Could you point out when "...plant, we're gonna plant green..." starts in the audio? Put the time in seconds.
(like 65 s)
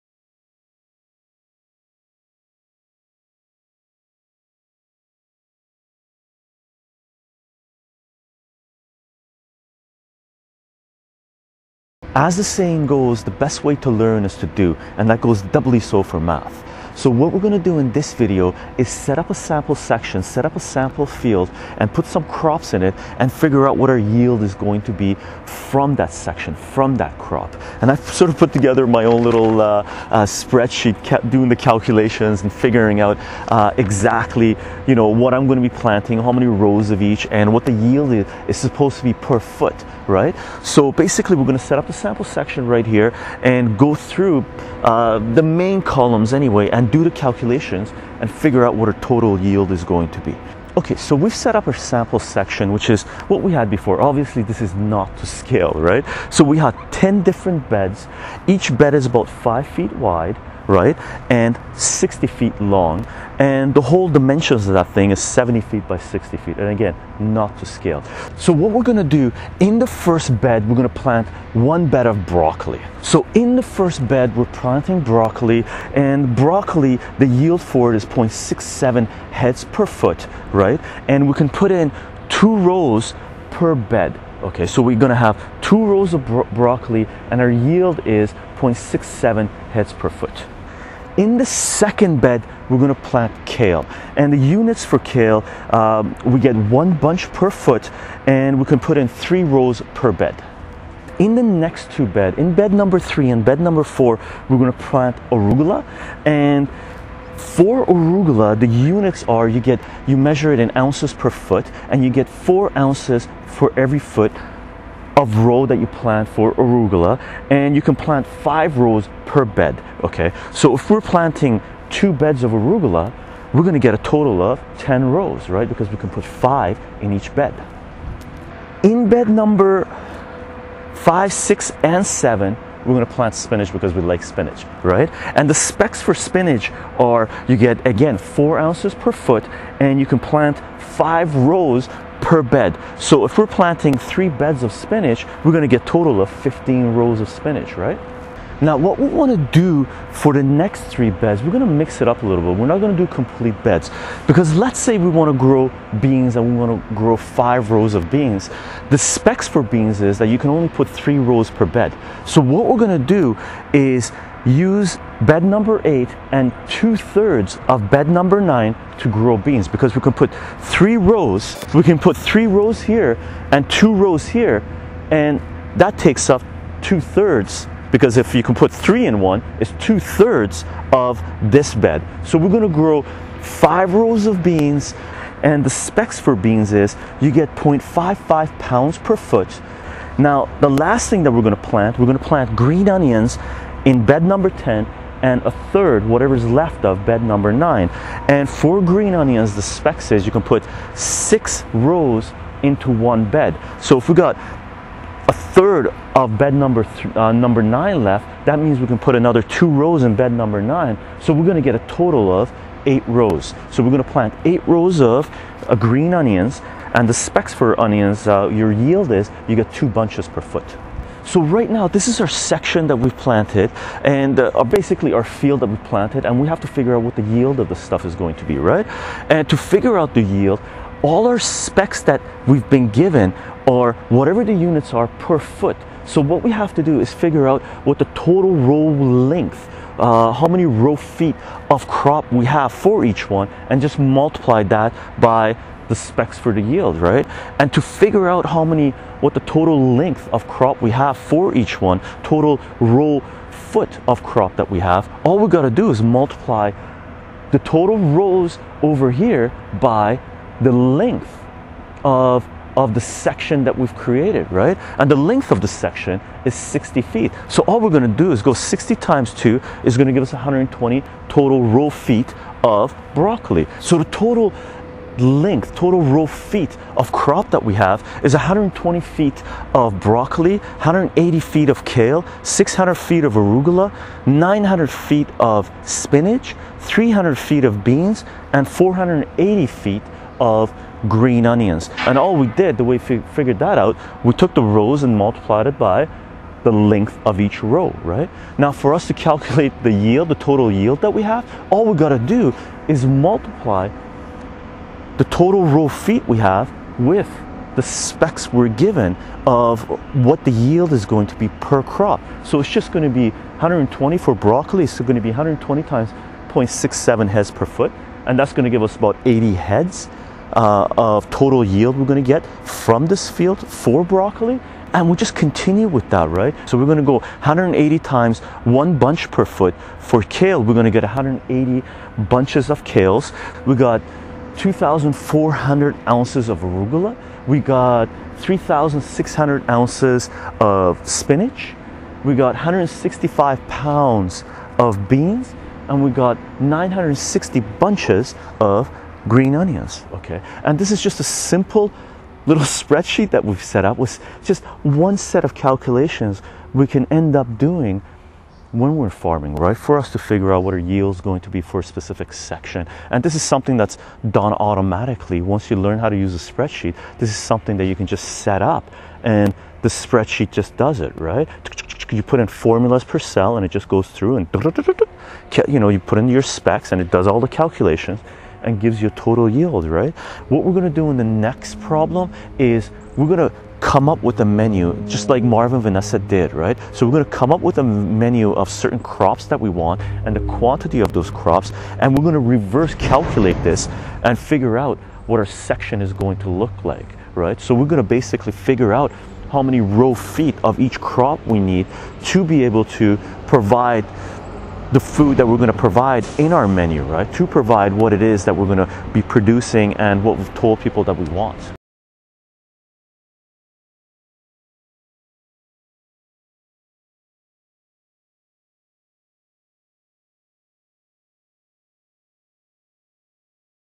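191 s.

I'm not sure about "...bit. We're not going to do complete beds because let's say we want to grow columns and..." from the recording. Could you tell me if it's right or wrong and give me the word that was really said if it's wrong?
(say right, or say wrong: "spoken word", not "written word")
wrong: "beans", not "columns".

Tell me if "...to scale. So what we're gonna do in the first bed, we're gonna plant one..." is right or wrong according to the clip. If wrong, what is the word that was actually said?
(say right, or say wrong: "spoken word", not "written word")
right.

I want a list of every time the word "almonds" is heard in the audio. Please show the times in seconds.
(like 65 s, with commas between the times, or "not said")
not said.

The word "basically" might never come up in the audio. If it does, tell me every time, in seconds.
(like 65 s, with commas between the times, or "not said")
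40 s, 224 s, 398 s.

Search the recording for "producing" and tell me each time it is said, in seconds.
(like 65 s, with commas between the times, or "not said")
409 s.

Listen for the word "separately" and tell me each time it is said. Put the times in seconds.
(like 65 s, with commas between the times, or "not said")
not said.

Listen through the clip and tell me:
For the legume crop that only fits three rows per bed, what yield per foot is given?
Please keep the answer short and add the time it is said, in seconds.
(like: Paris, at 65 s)
0.55 pounds, at 187 s.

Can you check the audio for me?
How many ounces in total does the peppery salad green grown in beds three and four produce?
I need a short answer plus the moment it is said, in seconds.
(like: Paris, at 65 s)
2,400 ounces, at 334 s.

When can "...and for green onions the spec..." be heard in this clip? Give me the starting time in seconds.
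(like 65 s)
198 s.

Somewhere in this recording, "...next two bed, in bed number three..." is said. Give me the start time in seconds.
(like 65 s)
101 s.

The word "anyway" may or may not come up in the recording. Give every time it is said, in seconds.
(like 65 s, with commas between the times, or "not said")
46 s.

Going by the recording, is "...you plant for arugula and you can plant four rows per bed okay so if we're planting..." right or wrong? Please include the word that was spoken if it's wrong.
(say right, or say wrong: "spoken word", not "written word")
wrong: "five", not "four".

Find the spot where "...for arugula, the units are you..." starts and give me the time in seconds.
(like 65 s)
107 s.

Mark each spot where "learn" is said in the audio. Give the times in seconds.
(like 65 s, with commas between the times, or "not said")
13 s, 365 s.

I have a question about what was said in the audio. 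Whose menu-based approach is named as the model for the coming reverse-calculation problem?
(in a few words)
Marvin Vanessa.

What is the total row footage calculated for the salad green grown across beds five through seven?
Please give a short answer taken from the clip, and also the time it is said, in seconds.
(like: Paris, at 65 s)
900 feet, at 284 s.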